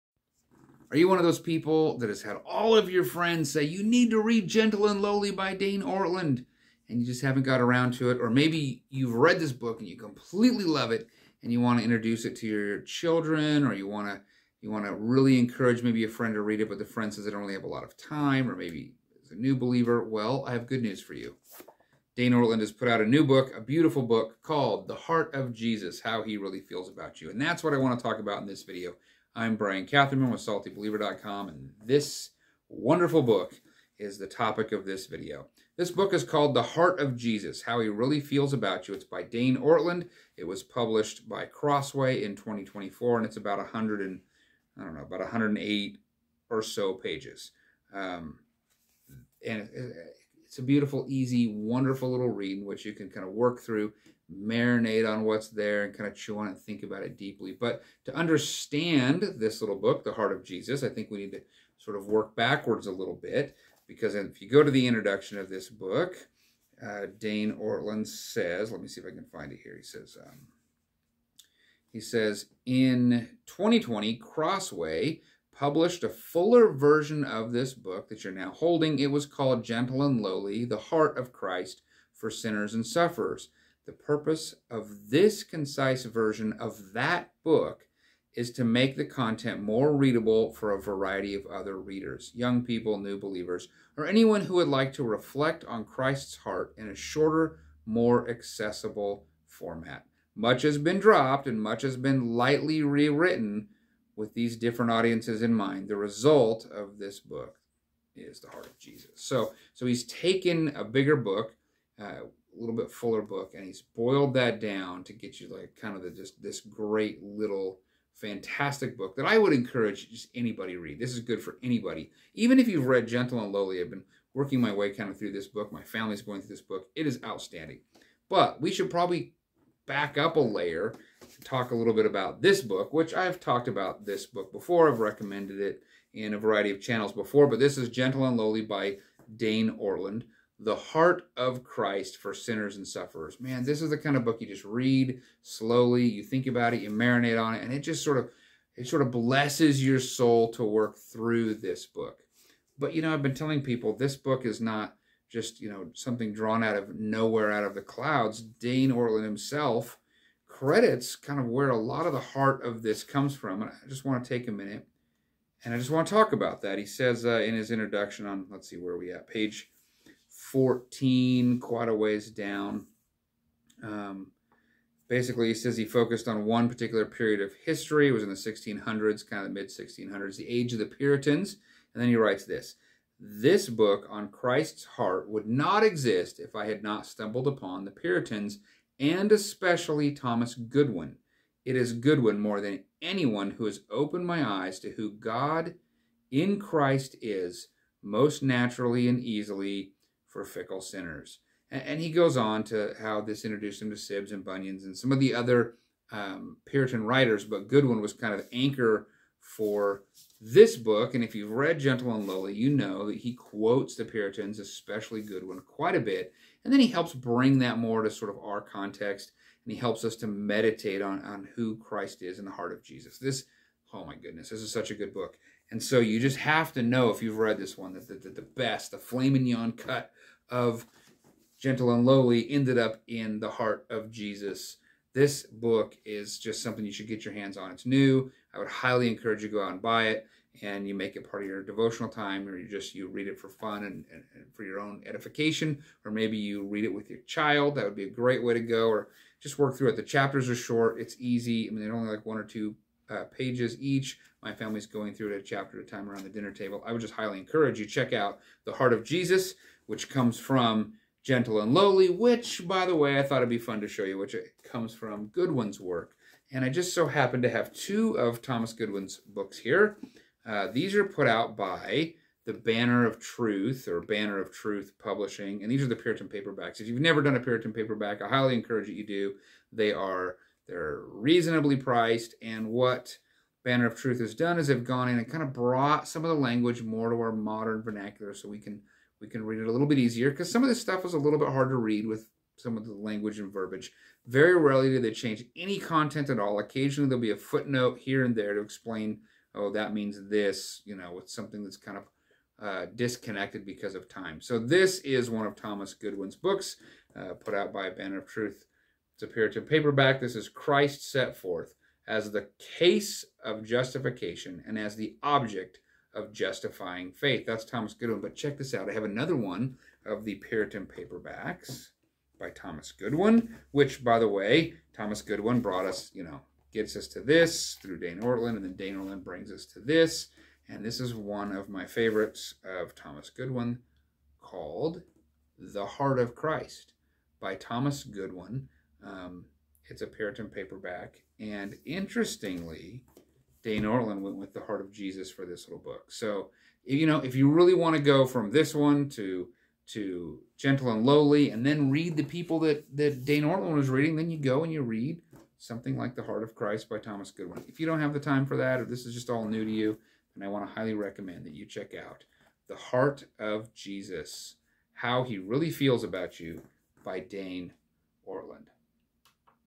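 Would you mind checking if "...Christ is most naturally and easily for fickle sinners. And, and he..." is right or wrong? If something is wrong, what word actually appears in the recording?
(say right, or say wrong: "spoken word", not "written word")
right.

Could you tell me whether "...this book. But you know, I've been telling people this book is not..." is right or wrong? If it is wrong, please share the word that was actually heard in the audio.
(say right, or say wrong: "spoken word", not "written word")
right.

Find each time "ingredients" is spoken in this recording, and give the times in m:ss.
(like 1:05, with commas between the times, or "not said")
not said.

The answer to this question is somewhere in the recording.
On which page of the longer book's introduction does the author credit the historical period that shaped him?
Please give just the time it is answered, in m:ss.
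2:49.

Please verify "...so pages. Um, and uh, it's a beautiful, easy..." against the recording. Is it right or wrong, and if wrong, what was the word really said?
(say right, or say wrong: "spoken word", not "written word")
right.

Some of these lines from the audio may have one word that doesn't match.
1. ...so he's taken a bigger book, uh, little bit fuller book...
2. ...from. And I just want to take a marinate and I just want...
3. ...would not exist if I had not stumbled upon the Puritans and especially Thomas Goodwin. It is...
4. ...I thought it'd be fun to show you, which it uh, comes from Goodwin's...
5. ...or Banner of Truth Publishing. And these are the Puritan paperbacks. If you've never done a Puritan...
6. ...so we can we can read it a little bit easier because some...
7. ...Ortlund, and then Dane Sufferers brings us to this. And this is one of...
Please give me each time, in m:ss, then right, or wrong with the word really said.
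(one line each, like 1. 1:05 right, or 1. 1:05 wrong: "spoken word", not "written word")
1. 1:49 right
2. 2:43 wrong: "minute", not "marinate"
3. 3:05 right
4. 4:23 right
5. 4:33 right
6. 4:48 right
7. 5:28 wrong: "Ortlund", not "Sufferers".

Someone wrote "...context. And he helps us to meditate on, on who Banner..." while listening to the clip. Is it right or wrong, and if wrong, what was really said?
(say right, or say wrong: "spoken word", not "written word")
wrong: "Christ", not "Banner".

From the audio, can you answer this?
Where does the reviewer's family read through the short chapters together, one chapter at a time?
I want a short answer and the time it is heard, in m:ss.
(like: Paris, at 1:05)
Around the dinner table, at 4:16.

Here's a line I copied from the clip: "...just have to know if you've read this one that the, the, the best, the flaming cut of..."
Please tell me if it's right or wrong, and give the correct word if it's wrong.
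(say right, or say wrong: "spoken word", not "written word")
right.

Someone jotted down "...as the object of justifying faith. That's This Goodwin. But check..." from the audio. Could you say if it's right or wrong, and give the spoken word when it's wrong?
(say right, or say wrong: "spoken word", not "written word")
wrong: "Thomas", not "This".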